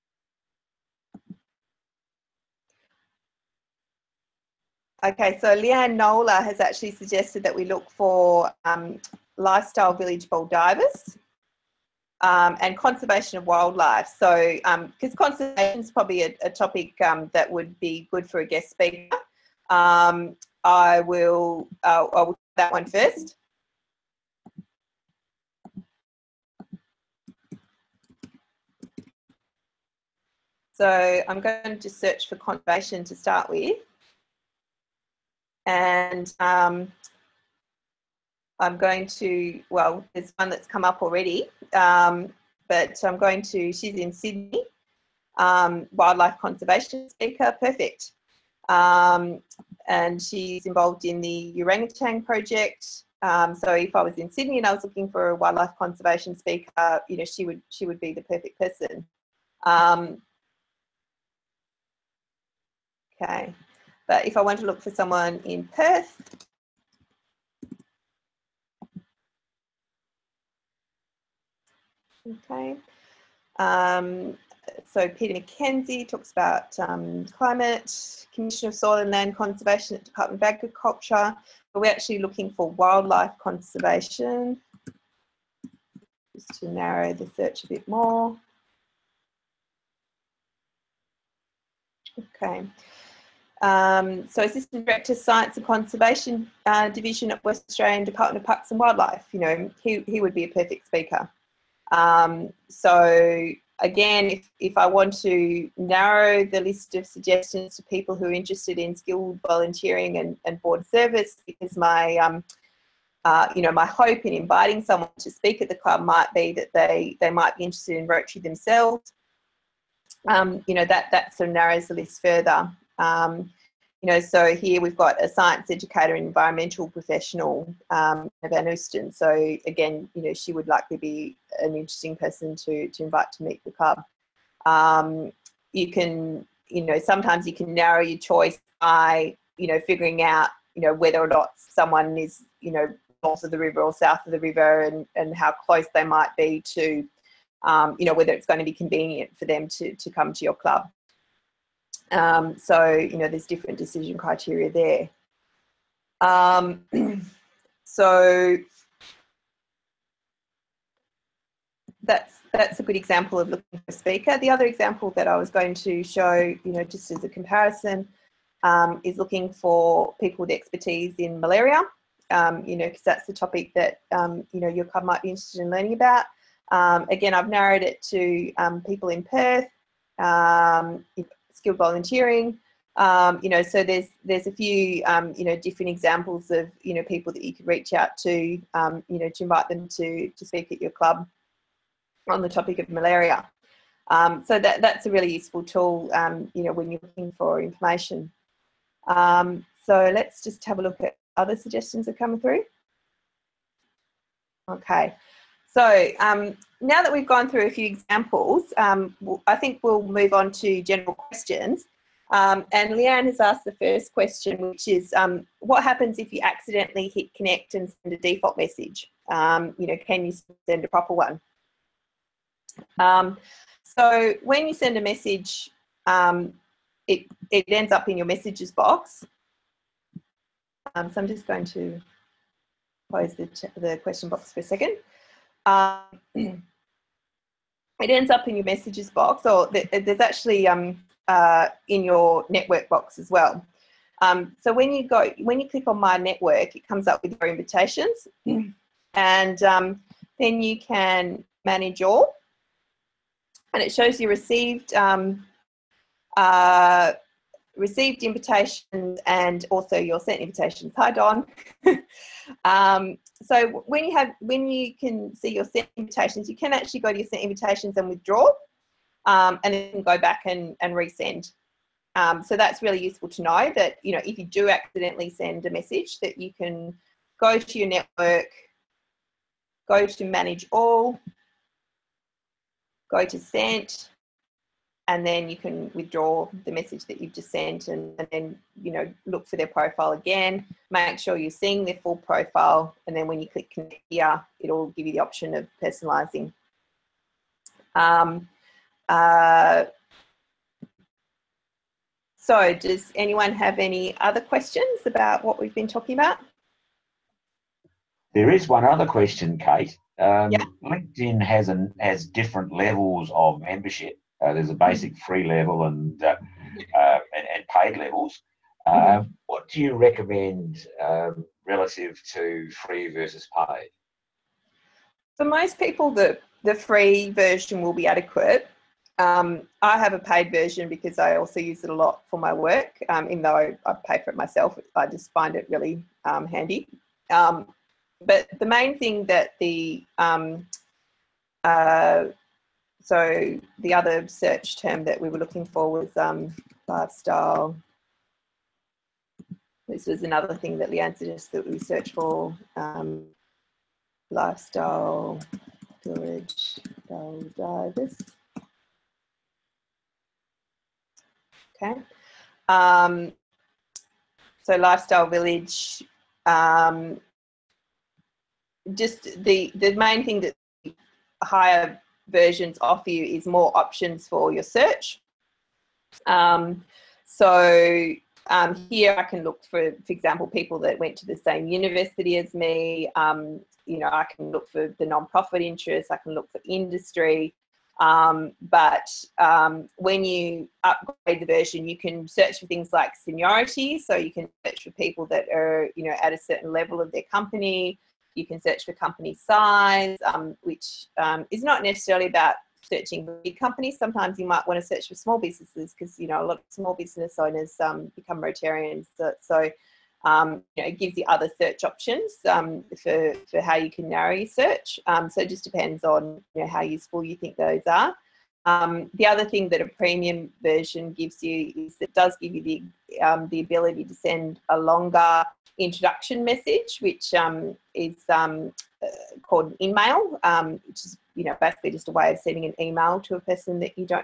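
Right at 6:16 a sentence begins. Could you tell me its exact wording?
Um, so um, here I can look for, for example, people that went to the same university as me.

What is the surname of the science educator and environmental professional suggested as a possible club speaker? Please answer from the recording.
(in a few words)
Van Oosten.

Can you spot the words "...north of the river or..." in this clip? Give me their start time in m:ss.
2:23.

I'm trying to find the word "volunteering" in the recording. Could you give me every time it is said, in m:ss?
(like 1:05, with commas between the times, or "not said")
1:49, 3:01.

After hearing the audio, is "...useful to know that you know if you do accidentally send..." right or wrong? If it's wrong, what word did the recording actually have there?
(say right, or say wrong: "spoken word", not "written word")
right.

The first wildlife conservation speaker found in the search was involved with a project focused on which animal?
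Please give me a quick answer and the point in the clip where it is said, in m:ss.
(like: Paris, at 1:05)
Orangutan, at 0:51.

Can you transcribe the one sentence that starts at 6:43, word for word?
Sometimes you might want to search for small businesses because you know a lot of small business owners um, become Rotarians.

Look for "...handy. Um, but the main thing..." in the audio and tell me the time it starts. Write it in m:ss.
5:36.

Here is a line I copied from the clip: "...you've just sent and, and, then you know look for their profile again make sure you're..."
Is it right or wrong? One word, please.
right.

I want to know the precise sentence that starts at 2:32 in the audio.
Um, so, you know, there's different decision criteria there.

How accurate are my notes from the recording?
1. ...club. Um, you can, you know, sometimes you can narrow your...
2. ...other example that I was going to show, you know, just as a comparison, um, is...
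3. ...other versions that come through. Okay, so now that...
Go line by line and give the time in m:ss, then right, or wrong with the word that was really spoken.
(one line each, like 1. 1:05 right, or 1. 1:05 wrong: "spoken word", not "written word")
1. 2:13 right
2. 2:44 right
3. 3:21 wrong: "suggestions", not "versions".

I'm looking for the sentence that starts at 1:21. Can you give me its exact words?
But we're actually looking for wildlife conservation, just to narrow the search a bit more.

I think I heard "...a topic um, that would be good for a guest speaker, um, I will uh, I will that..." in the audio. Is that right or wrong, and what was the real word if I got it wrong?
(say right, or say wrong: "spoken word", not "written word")
right.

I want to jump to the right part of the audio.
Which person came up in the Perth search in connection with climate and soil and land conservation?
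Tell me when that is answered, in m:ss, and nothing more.
1:15.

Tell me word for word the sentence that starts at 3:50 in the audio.
so I'm just going to close the, the question box for a second.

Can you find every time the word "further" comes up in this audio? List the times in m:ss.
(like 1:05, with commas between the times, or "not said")
2:02.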